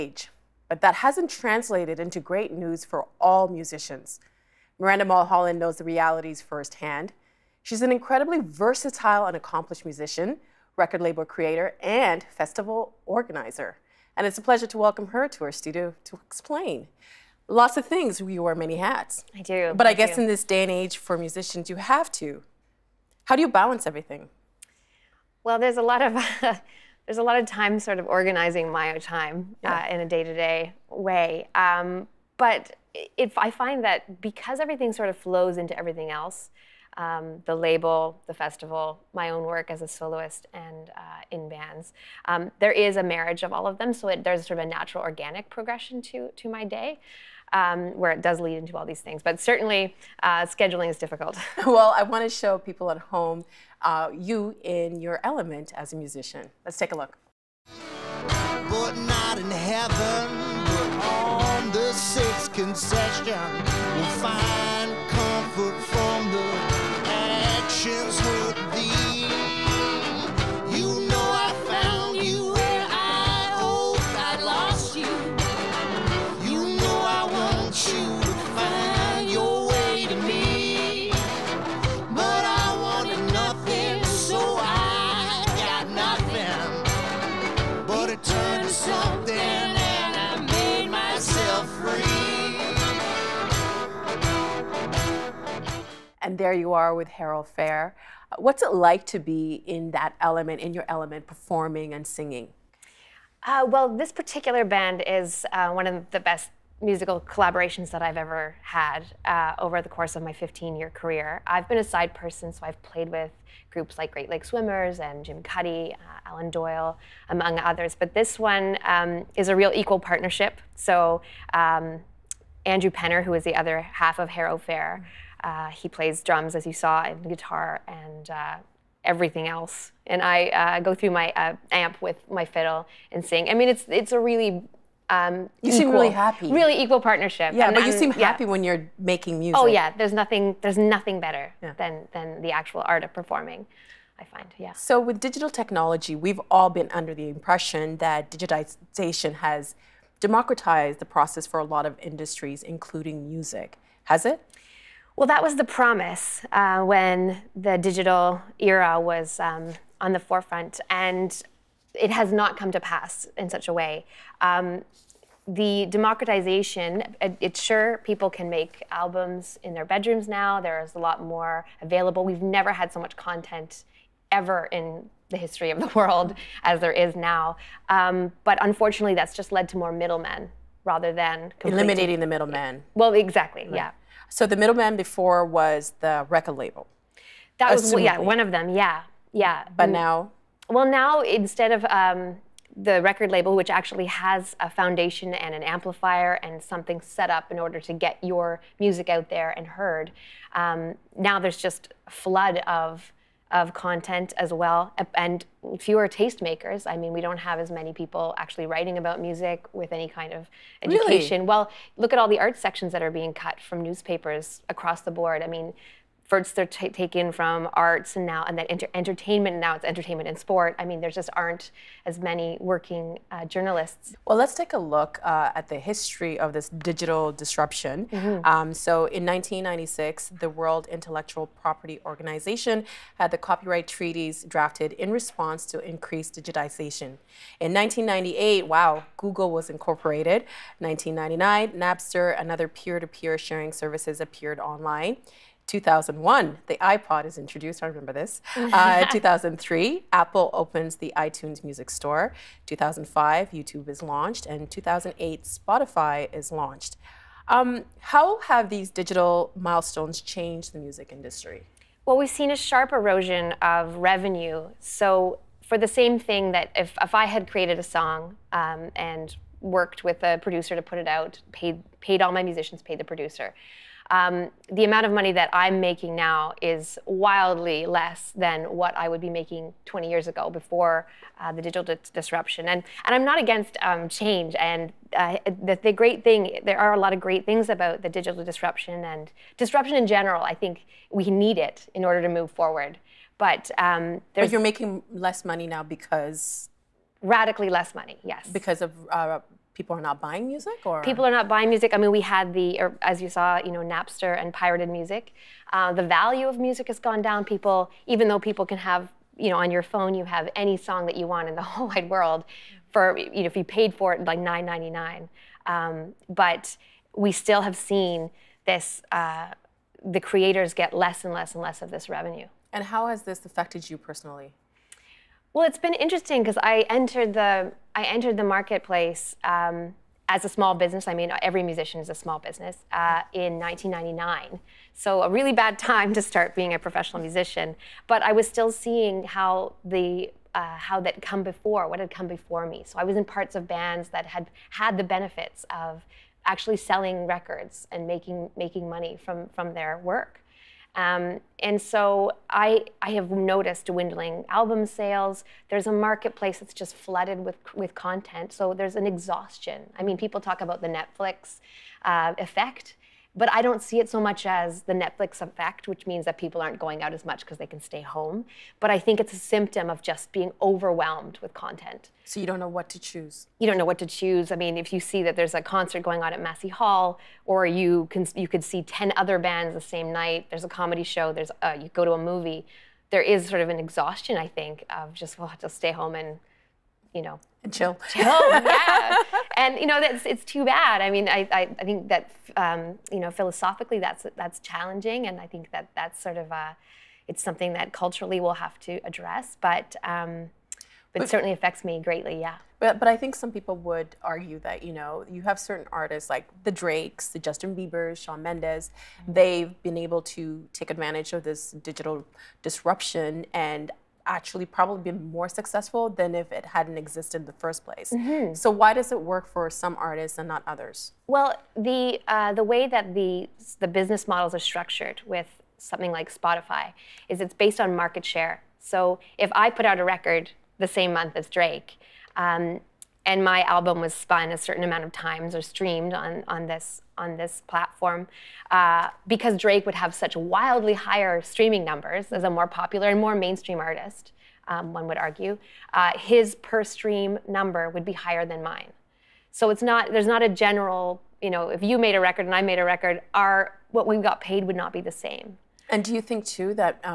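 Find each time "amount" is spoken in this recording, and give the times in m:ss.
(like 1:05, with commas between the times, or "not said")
4:34, 7:14.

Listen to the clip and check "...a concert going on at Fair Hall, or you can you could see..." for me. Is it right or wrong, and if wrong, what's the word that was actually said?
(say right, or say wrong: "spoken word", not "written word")
wrong: "Massey", not "Fair".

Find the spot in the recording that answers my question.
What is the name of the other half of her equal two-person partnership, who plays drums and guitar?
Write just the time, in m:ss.
2:02.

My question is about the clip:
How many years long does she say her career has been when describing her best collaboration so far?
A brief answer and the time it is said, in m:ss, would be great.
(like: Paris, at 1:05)
15, at 1:50.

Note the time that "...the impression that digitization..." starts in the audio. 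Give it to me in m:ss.
2:27.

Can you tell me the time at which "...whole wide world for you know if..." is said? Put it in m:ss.
5:11.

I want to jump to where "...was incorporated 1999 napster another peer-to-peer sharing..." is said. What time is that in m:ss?
3:59.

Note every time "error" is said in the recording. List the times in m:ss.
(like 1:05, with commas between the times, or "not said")
not said.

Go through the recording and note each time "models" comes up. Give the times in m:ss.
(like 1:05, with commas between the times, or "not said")
7:04.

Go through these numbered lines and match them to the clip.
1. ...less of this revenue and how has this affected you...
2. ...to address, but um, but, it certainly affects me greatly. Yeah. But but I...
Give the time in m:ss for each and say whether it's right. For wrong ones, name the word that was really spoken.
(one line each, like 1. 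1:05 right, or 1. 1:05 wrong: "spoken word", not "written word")
1. 5:21 right
2. 6:38 right.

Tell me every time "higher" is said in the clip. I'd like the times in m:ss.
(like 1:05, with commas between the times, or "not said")
7:20, 7:28.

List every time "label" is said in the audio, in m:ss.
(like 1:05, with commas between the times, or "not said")
0:11, 0:37, 3:06, 3:13.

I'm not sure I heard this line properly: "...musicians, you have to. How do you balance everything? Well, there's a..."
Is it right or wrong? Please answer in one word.
right.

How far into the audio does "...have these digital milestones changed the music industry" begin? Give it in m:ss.
4:18.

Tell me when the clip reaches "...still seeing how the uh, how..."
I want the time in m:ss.
5:38.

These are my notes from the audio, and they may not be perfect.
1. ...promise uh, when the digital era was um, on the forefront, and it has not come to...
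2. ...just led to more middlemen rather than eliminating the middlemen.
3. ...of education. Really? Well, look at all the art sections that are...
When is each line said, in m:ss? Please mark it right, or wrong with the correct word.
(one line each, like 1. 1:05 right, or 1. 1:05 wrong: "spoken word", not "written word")
1. 2:35 right
2. 2:59 right
3. 3:30 right.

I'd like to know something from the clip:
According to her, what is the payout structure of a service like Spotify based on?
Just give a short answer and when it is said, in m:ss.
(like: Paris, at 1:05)
Market share, at 7:08.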